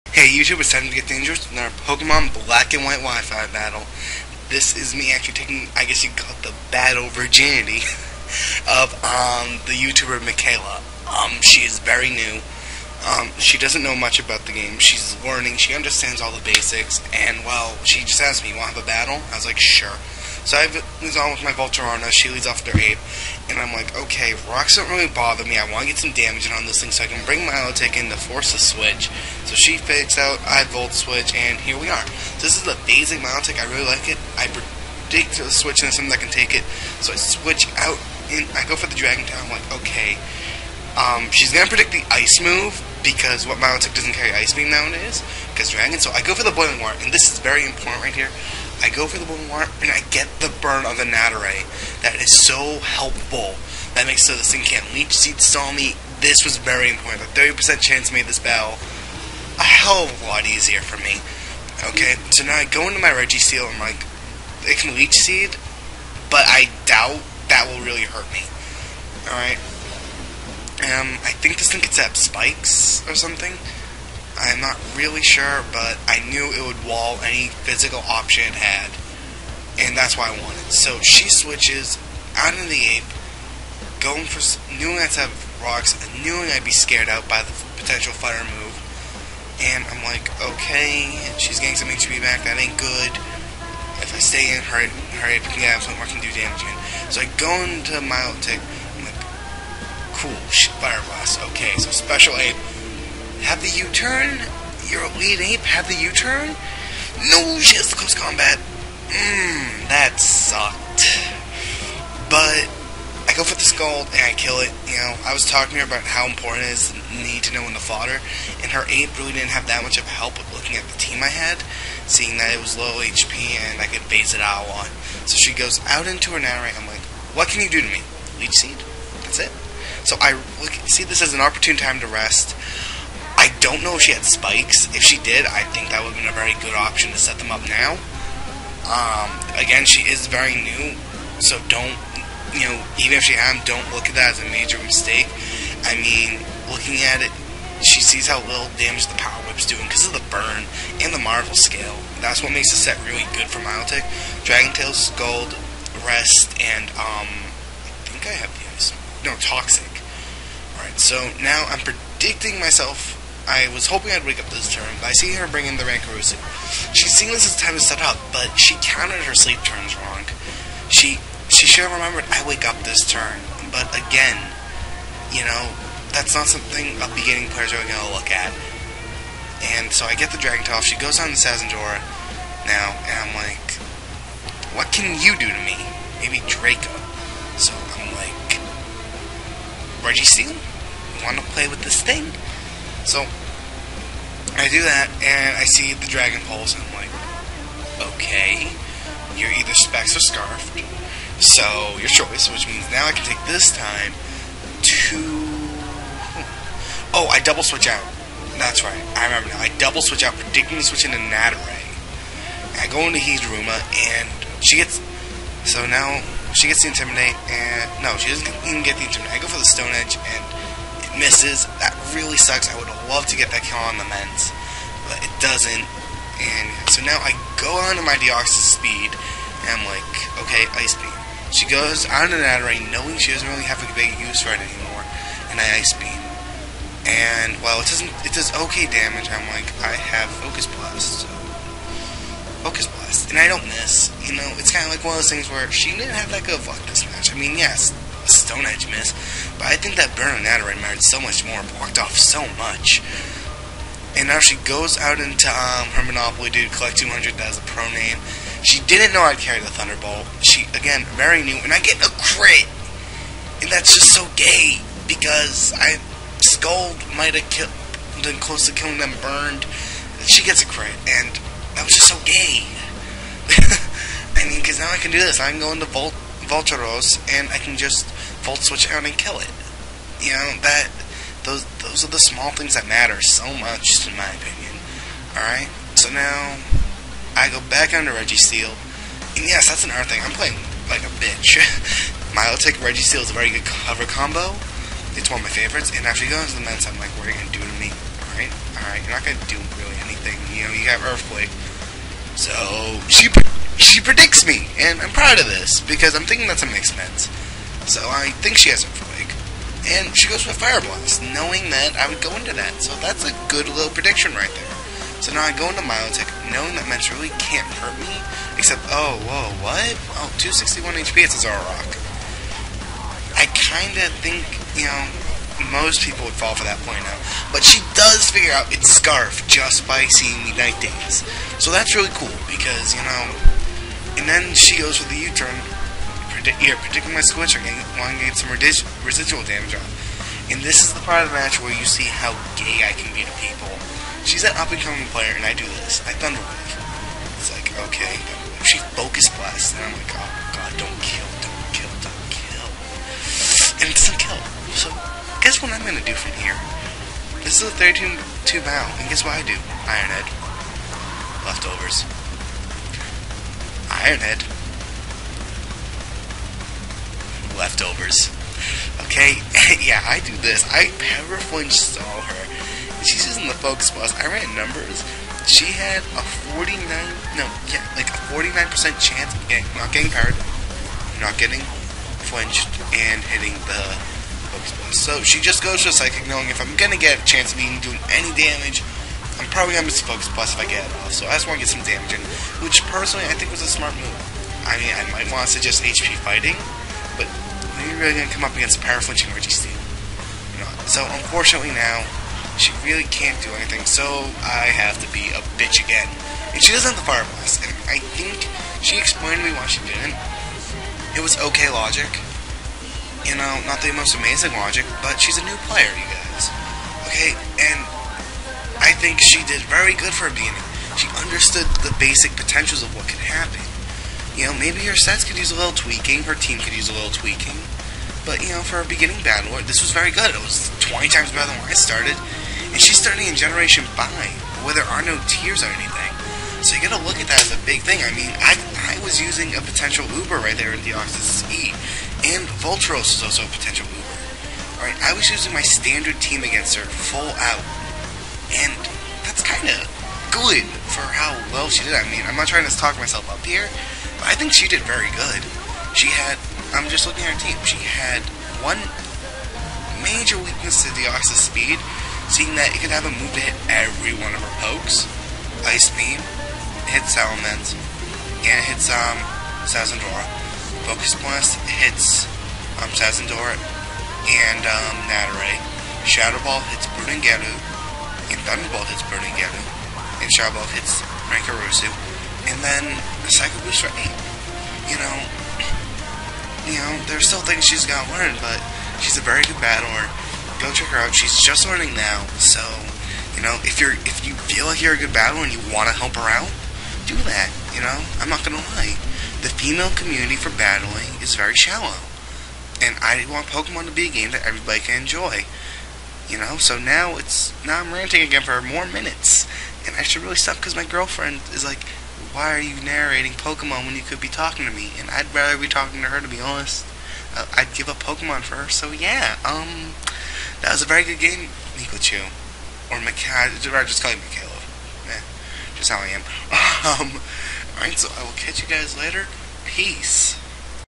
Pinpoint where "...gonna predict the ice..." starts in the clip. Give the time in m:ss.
0:41.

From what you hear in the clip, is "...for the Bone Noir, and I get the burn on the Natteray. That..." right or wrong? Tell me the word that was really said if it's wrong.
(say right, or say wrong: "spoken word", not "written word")
right.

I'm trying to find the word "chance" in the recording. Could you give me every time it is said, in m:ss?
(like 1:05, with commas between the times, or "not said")
0:57, 6:19, 6:27.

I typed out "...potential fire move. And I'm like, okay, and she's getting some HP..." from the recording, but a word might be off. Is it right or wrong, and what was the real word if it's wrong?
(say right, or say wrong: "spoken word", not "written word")
right.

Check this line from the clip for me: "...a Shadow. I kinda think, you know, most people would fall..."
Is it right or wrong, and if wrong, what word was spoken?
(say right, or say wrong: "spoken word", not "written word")
wrong: "Zoroark", not "Shadow".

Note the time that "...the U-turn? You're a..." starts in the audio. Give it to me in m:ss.
1:43.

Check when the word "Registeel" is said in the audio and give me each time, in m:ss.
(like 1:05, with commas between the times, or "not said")
1:03, 3:10, 4:48, 4:52, 6:39.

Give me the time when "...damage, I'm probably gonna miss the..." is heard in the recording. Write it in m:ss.
6:28.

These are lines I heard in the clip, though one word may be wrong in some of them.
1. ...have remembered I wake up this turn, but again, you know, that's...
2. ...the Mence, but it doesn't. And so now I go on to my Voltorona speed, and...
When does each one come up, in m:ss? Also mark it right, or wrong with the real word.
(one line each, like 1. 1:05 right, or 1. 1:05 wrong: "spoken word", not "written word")
1. 2:51 right
2. 3:43 wrong: "Deoxys", not "Voltorona".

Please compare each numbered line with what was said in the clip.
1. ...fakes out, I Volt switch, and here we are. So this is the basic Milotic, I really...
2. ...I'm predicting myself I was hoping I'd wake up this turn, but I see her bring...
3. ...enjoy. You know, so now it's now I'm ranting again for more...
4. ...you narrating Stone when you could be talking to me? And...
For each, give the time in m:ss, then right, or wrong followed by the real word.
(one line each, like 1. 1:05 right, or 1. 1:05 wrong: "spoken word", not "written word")
1. 0:29 right
2. 2:41 right
3. 8:25 right
4. 8:32 wrong: "Pokemon", not "Stone".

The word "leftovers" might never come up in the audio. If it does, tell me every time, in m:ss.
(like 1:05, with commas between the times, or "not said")
6:01, 6:07.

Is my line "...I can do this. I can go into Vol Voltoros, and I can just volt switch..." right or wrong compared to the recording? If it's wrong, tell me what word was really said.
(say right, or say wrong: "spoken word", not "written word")
right.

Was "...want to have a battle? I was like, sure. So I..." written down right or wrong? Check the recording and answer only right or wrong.
right.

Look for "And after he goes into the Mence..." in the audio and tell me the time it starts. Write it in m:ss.
4:55.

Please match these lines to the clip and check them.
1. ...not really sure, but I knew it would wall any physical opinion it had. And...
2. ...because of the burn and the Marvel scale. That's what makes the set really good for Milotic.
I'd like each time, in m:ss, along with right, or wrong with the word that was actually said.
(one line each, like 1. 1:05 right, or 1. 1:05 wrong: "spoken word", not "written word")
1. 1:14 wrong: "option", not "opinion"
2. 2:29 right.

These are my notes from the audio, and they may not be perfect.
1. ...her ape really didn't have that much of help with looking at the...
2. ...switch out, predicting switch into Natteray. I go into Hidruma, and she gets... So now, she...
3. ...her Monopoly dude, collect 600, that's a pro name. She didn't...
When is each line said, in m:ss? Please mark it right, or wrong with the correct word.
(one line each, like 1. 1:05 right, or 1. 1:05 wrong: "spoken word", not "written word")
1. 1:58 right
2. 3:30 right
3. 4:15 wrong: "200", not "600".